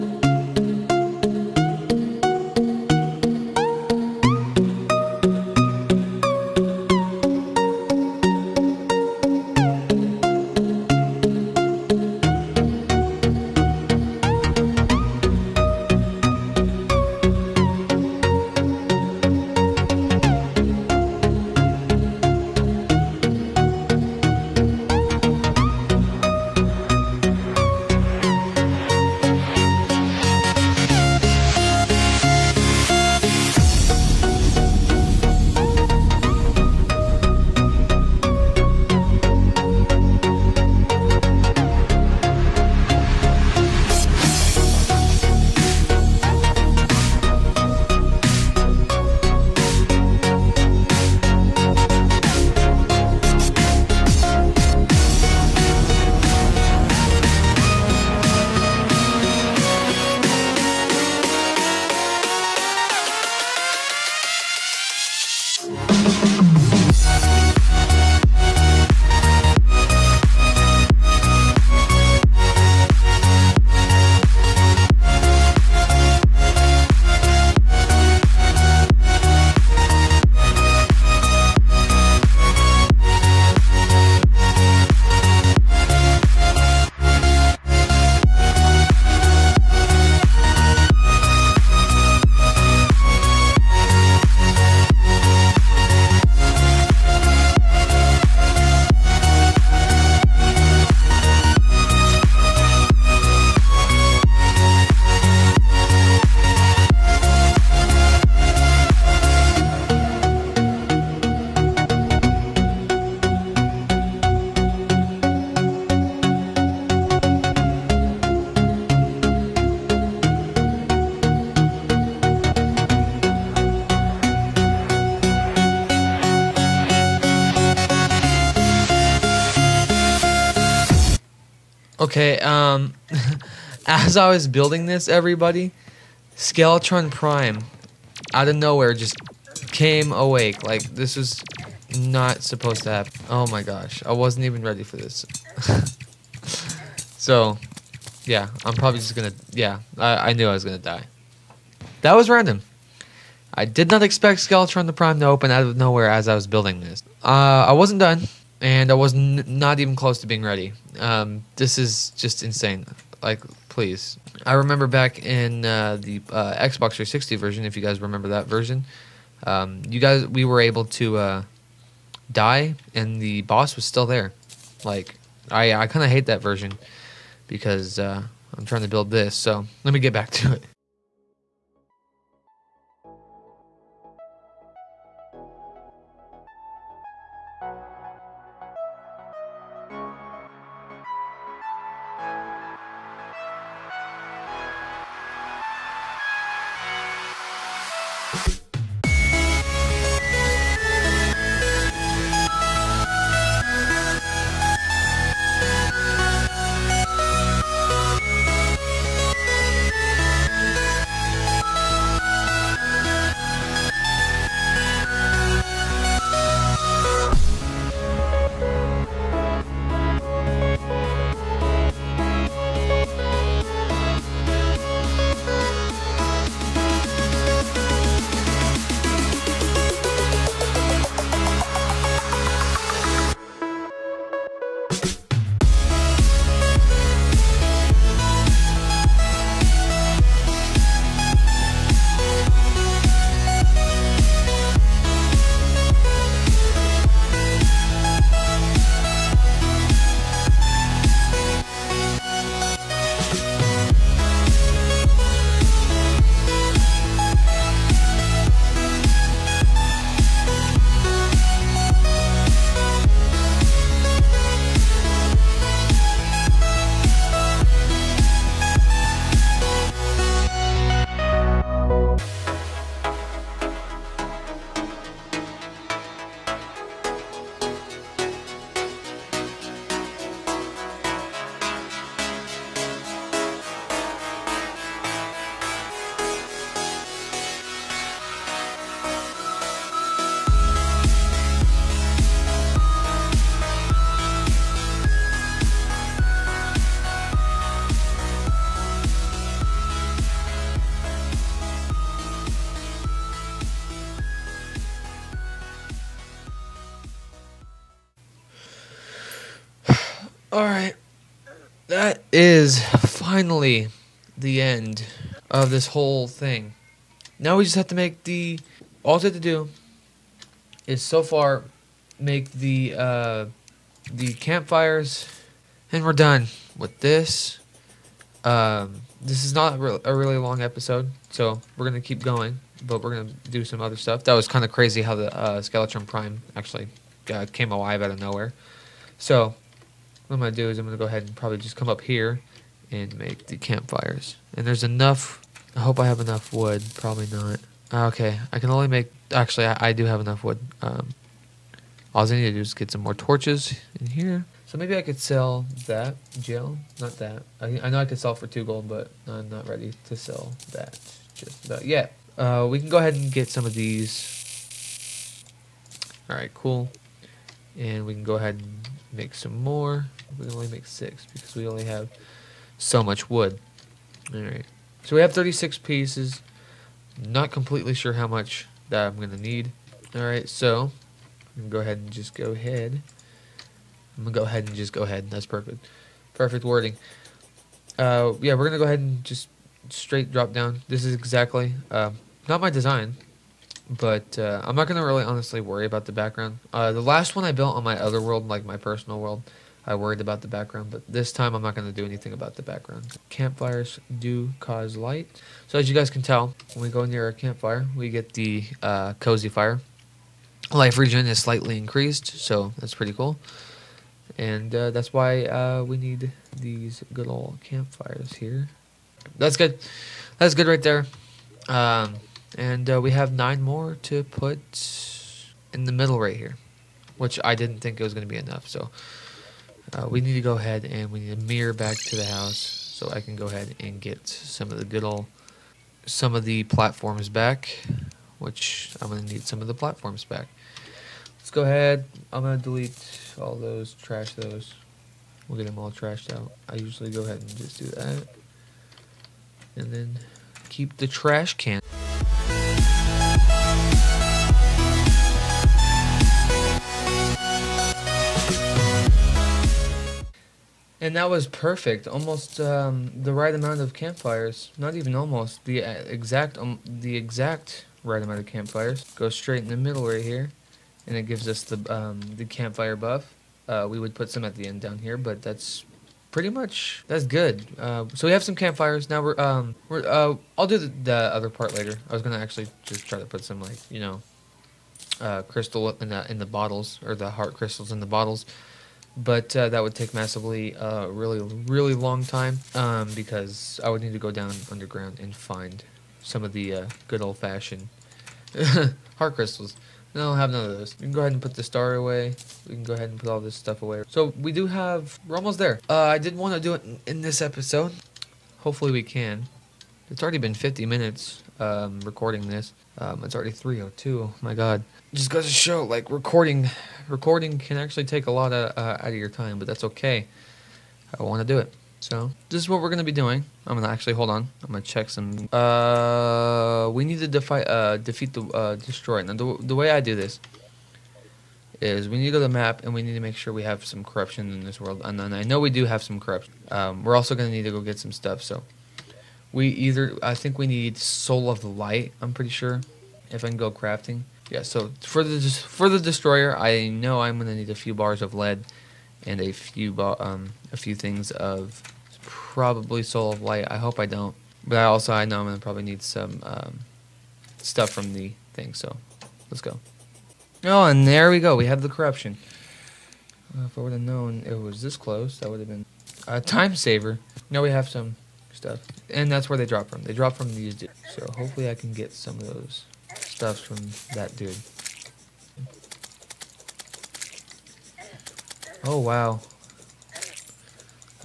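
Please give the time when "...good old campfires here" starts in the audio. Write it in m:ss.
6:57.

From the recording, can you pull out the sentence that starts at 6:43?
Campfires do cause light, so as you guys can tell, when we go near a campfire, we get the uh, cozy fire.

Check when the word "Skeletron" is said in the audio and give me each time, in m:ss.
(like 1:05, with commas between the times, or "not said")
2:16, 2:34, 5:35.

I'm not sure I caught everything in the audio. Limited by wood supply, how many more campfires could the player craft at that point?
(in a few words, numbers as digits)
six.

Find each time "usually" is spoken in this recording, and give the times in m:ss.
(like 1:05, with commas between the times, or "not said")
7:26.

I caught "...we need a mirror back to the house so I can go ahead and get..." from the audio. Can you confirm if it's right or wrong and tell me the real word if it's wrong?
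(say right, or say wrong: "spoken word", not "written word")
right.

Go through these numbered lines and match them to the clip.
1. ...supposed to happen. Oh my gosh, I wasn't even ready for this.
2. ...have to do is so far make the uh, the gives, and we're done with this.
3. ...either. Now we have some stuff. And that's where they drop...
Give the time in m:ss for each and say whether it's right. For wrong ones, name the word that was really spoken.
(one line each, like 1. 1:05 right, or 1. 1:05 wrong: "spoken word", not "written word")
1. 2:22 right
2. 5:19 wrong: "campfires", not "gives"
3. 9:26 wrong: "saver", not "either".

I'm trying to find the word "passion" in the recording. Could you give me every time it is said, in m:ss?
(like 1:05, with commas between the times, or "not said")
not said.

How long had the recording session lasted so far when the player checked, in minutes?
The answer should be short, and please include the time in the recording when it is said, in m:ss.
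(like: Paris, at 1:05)
50 minutes, at 8:30.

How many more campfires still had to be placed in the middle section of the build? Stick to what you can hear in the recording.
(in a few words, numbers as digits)
nine.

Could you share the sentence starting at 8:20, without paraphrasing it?
No, I don't have none of those.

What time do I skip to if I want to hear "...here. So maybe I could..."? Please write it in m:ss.
5:54.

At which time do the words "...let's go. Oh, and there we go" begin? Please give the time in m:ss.
9:19.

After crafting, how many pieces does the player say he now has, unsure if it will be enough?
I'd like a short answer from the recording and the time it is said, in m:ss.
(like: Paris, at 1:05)
36, at 6:15.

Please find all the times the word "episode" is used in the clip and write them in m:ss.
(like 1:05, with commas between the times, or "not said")
5:30, 8:27.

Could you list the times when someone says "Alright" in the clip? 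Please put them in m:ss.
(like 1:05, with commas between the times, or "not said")
6:14, 6:20.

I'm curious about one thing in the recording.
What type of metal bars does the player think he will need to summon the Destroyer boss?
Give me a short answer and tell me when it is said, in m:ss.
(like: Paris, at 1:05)
lead, at 9:08.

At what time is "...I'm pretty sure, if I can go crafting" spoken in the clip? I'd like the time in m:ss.
9:02.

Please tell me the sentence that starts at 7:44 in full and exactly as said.
Not even almost the uh, exact um, the exact right amount of campfires.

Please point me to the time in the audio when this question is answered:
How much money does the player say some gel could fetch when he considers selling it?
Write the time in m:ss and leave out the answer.
5:58.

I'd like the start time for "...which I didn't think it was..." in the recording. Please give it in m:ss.
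7:07.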